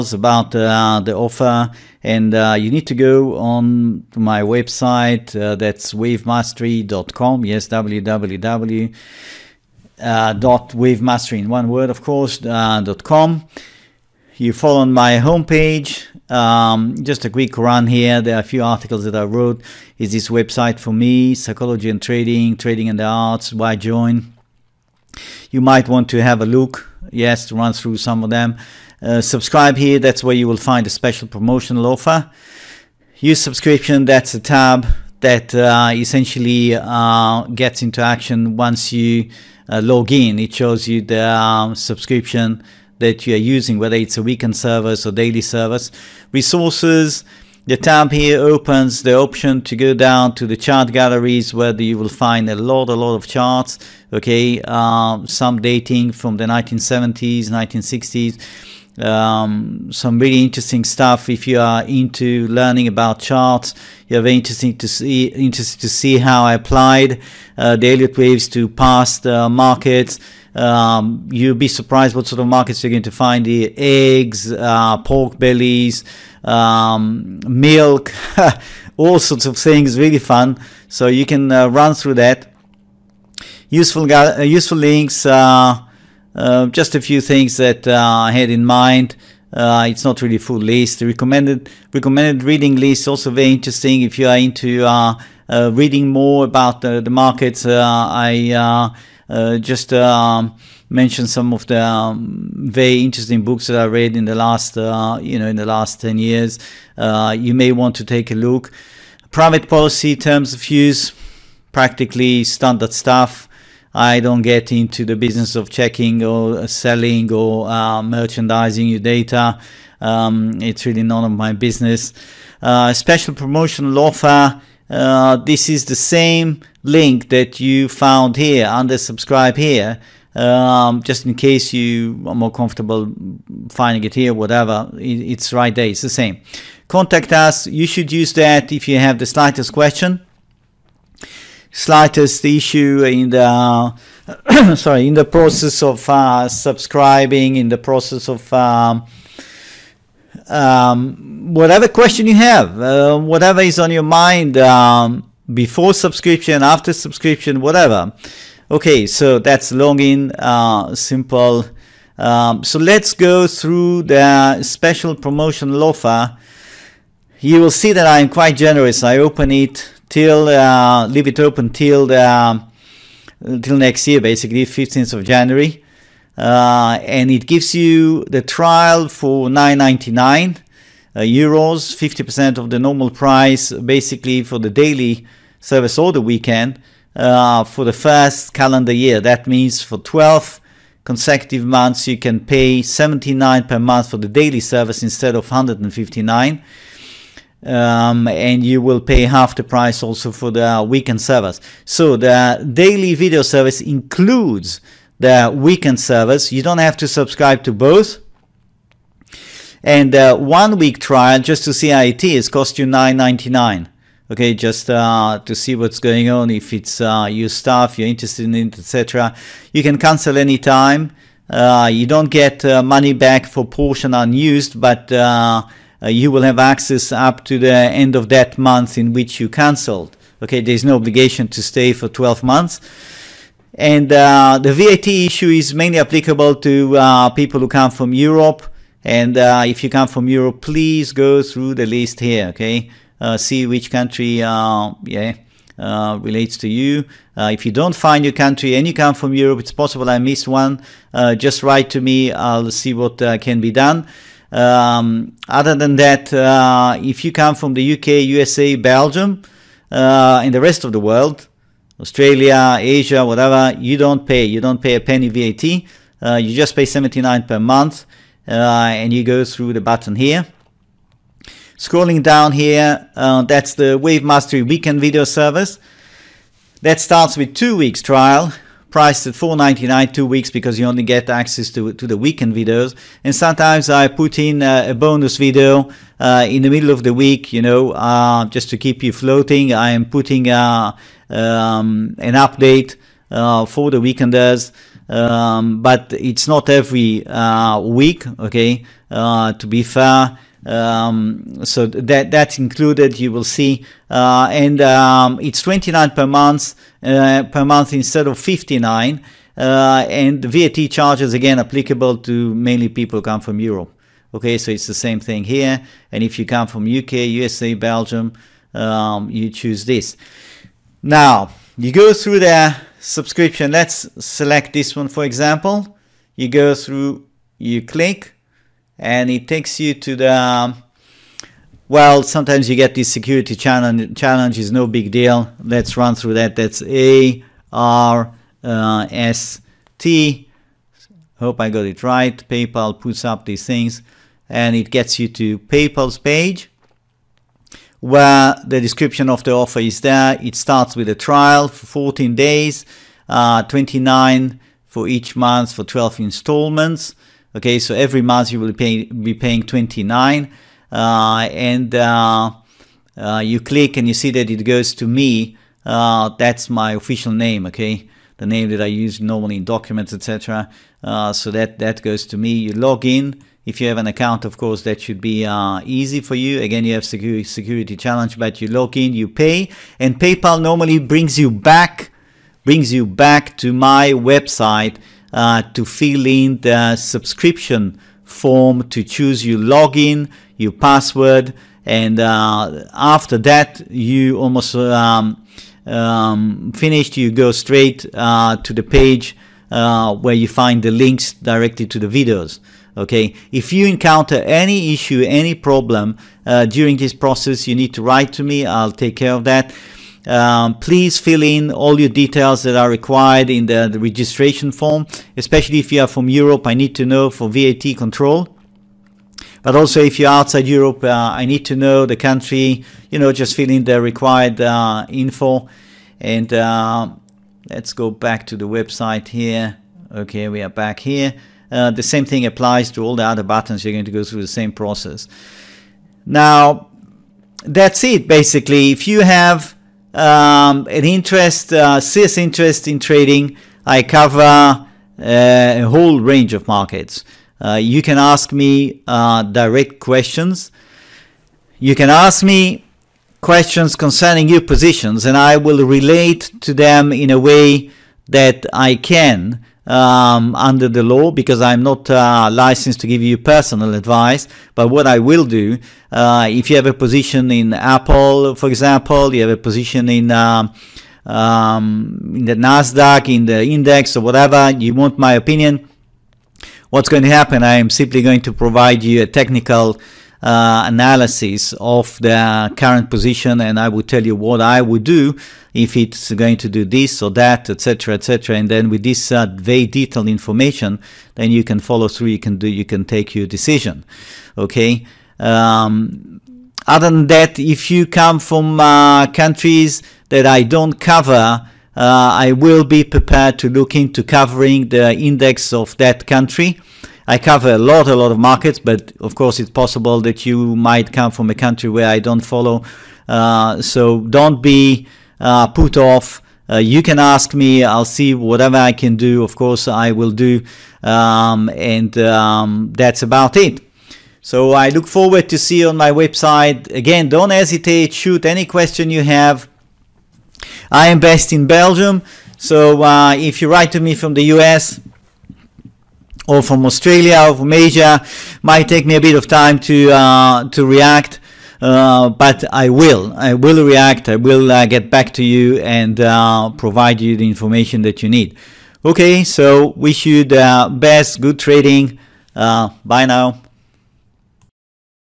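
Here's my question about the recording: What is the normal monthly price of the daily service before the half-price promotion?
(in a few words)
159.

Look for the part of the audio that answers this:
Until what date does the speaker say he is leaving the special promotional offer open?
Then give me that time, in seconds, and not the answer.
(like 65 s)
174 s.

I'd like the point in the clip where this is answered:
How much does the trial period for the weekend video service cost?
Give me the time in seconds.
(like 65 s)
279 s.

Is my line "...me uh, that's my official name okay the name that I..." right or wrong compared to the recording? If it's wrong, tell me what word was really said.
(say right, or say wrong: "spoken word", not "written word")
right.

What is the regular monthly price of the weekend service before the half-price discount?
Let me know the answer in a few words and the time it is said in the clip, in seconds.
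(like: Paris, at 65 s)
59, at 308 s.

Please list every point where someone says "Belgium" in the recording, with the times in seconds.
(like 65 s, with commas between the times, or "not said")
258 s, 317 s, 531 s.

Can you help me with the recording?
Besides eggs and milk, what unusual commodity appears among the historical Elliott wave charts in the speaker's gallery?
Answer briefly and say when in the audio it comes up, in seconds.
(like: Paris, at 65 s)
Pork bellies, at 74 s.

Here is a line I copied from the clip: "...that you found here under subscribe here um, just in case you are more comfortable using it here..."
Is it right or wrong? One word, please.
wrong.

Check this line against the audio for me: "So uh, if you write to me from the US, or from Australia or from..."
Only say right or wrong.
right.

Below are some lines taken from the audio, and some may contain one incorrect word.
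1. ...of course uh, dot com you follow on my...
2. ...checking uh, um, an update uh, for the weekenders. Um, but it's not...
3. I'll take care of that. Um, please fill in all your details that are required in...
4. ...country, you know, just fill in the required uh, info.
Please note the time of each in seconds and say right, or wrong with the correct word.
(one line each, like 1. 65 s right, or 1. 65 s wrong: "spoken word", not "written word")
1. 11 s right
2. 290 s wrong: "putting", not "checking"
3. 408 s right
4. 422 s right.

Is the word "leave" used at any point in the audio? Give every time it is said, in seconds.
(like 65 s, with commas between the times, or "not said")
171 s.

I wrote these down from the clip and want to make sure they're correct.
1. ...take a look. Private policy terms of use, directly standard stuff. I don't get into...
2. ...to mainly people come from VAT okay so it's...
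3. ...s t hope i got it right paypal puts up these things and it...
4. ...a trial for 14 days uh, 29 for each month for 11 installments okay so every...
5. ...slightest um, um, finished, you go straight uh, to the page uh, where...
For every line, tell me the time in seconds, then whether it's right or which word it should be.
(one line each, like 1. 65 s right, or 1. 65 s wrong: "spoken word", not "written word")
1. 108 s wrong: "practically", not "directly"
2. 312 s wrong: "Europe", not "VAT"
3. 339 s right
4. 351 s wrong: "12", not "11"
5. 394 s wrong: "almost", not "slightest".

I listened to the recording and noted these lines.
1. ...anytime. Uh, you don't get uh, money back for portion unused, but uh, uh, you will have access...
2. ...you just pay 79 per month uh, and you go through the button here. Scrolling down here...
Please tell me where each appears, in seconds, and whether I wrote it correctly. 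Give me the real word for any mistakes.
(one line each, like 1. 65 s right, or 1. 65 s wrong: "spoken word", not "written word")
1. 220 s right
2. 266 s right.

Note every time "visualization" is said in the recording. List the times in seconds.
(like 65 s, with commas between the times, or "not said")
not said.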